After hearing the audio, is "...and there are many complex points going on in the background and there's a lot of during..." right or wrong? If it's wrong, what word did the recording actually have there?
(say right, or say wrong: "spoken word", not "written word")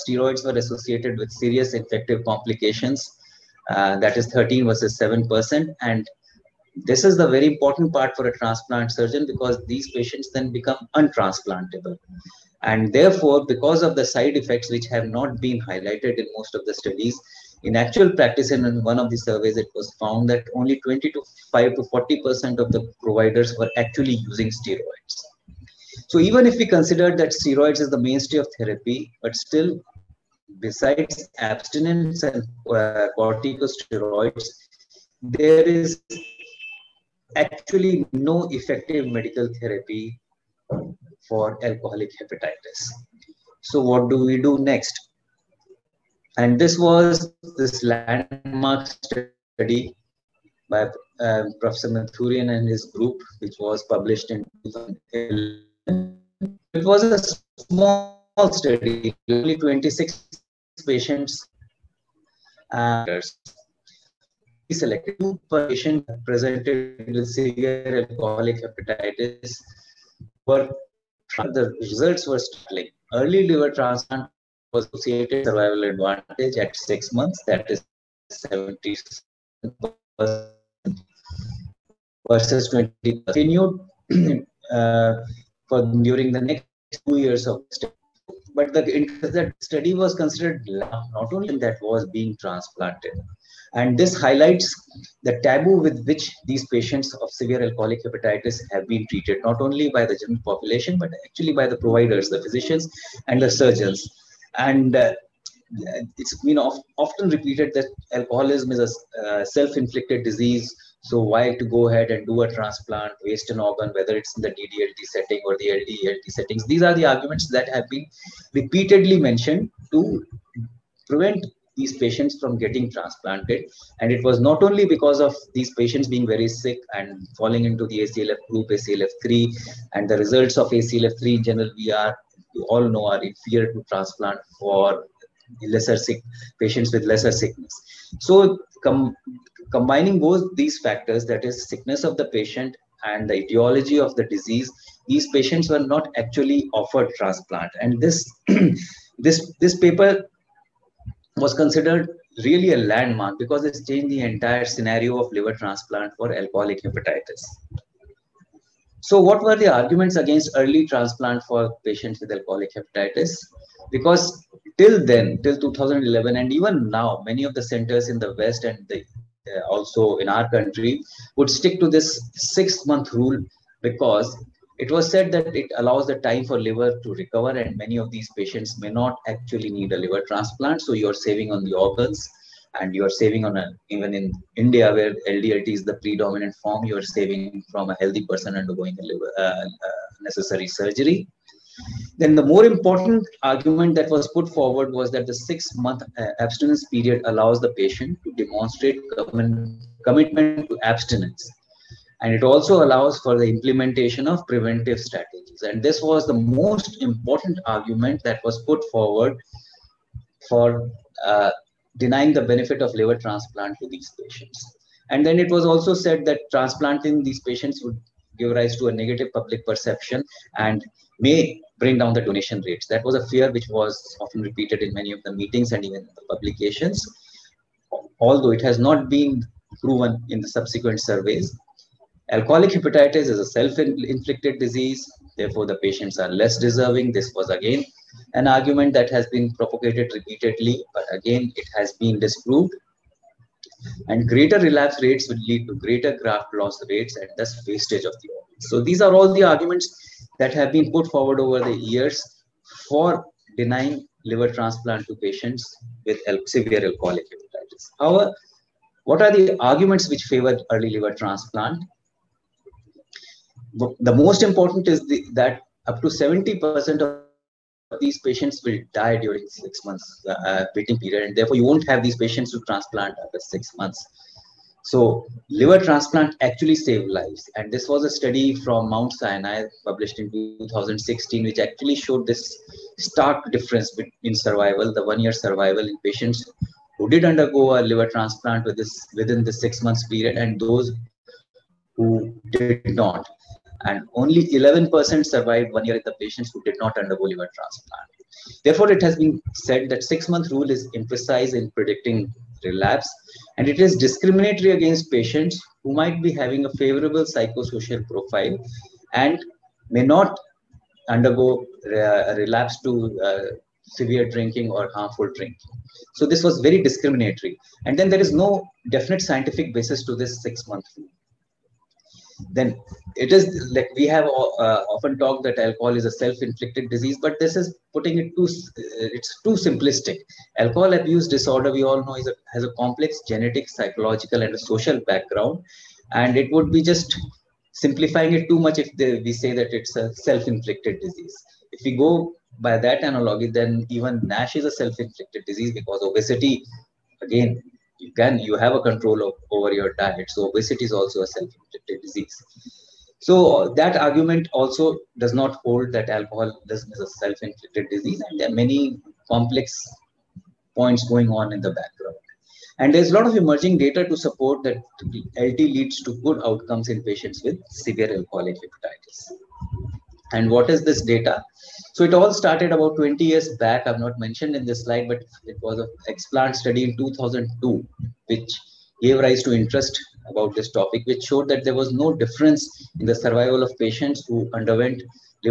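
wrong: "emerging", not "during".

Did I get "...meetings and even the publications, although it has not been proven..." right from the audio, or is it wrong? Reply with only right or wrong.
right.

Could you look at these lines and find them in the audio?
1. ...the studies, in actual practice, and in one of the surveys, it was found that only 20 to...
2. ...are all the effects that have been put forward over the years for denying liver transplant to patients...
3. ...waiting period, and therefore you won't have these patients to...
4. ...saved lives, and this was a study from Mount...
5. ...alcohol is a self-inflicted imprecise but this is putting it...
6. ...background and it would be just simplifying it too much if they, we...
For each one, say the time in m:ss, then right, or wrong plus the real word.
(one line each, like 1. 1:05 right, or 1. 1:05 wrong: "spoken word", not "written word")
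1. 0:16 right
2. 4:09 wrong: "arguments", not "effects"
3. 4:30 right
4. 4:36 right
5. 5:25 wrong: "disease", not "imprecise"
6. 5:35 right.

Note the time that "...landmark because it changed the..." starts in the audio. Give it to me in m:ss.
2:32.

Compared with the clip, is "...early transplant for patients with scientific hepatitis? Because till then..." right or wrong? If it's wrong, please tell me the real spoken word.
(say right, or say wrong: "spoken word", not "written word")
wrong: "alcoholic", not "scientific".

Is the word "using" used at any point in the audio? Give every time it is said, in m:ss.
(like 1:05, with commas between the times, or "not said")
0:24.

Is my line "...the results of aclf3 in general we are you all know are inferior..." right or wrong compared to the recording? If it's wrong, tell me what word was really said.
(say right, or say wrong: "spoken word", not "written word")
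right.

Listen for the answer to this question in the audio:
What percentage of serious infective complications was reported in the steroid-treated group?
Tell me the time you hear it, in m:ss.
0:04.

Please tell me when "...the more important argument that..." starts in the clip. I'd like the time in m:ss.
3:12.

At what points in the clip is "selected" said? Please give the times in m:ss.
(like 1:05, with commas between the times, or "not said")
1:04.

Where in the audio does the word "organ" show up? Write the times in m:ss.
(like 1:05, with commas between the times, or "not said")
1:53, 3:01, 4:08.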